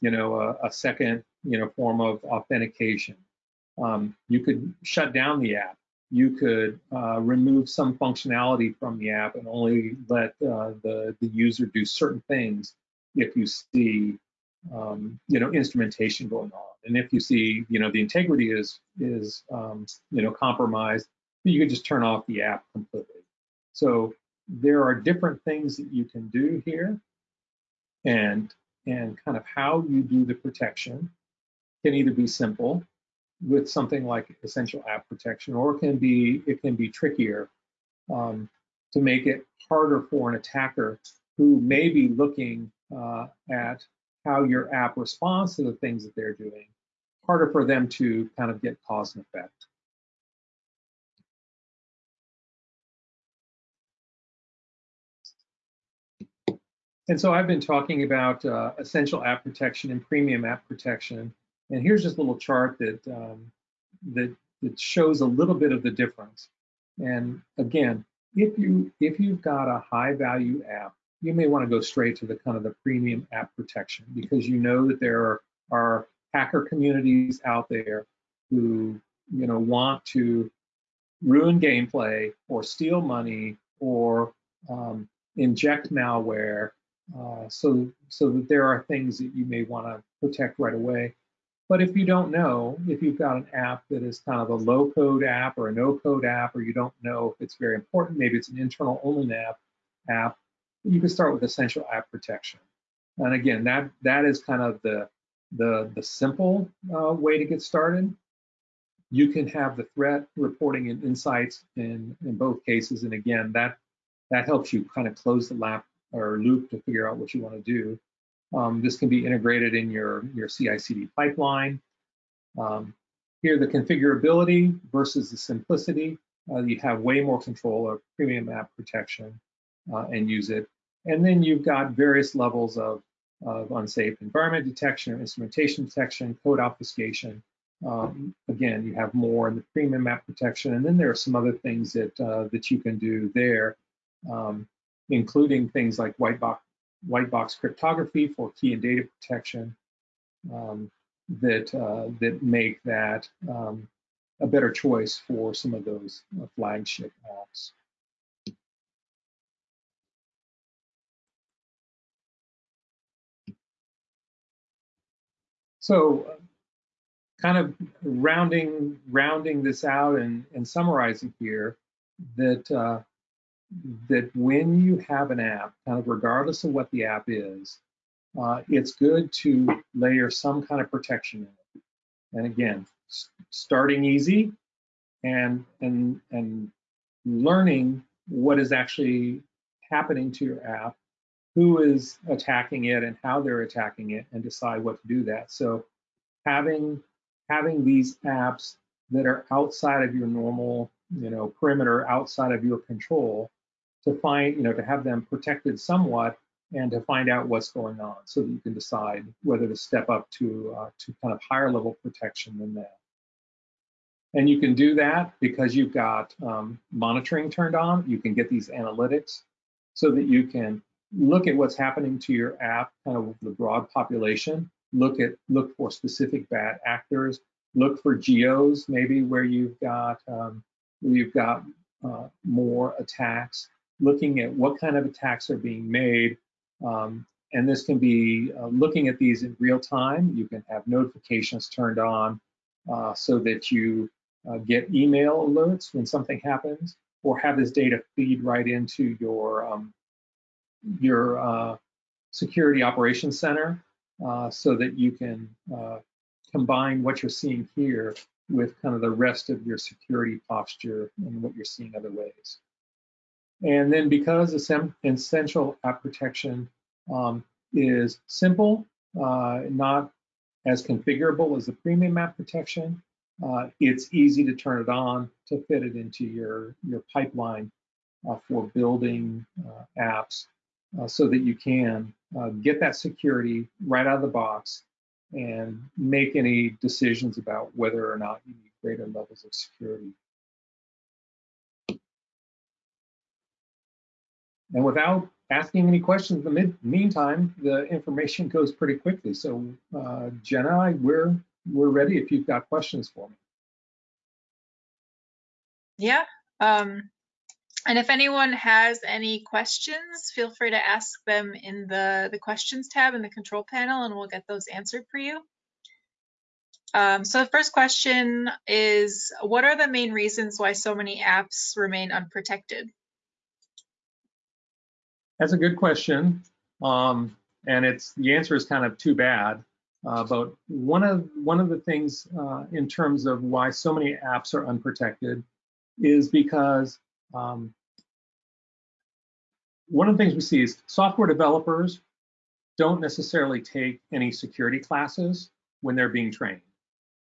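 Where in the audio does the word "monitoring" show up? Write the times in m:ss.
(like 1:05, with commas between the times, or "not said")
3:36.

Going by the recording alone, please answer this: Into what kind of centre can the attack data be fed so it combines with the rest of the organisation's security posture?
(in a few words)
security operations center.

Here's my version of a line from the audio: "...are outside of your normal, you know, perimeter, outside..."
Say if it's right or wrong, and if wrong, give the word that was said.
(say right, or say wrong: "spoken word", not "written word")
right.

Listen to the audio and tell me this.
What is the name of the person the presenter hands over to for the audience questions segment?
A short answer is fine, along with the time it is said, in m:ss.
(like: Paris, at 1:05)
Jenna, at 5:00.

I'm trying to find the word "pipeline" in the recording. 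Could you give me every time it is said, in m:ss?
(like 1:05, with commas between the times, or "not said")
2:01, 4:37.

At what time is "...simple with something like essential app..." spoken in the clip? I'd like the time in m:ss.
0:32.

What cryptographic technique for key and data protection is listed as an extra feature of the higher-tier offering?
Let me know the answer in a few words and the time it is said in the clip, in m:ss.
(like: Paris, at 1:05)
white box cryptography, at 2:27.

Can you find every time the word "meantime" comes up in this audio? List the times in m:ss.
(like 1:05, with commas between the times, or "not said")
4:56.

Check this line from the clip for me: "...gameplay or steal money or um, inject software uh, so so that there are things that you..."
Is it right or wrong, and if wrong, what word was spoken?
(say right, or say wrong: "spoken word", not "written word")
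wrong: "malware", not "software".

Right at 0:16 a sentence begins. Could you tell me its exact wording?
And if you see you know the integrity is is um, you know compromised, you can just turn off the app completely.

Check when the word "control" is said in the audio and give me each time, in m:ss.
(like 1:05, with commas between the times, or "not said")
2:07, 3:22, 5:13.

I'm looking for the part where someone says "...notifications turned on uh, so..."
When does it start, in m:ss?
4:00.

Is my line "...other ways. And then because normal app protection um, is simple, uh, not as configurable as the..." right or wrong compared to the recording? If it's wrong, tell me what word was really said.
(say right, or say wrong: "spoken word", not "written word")
wrong: "essential", not "normal".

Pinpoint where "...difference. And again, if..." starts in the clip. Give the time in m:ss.
1:05.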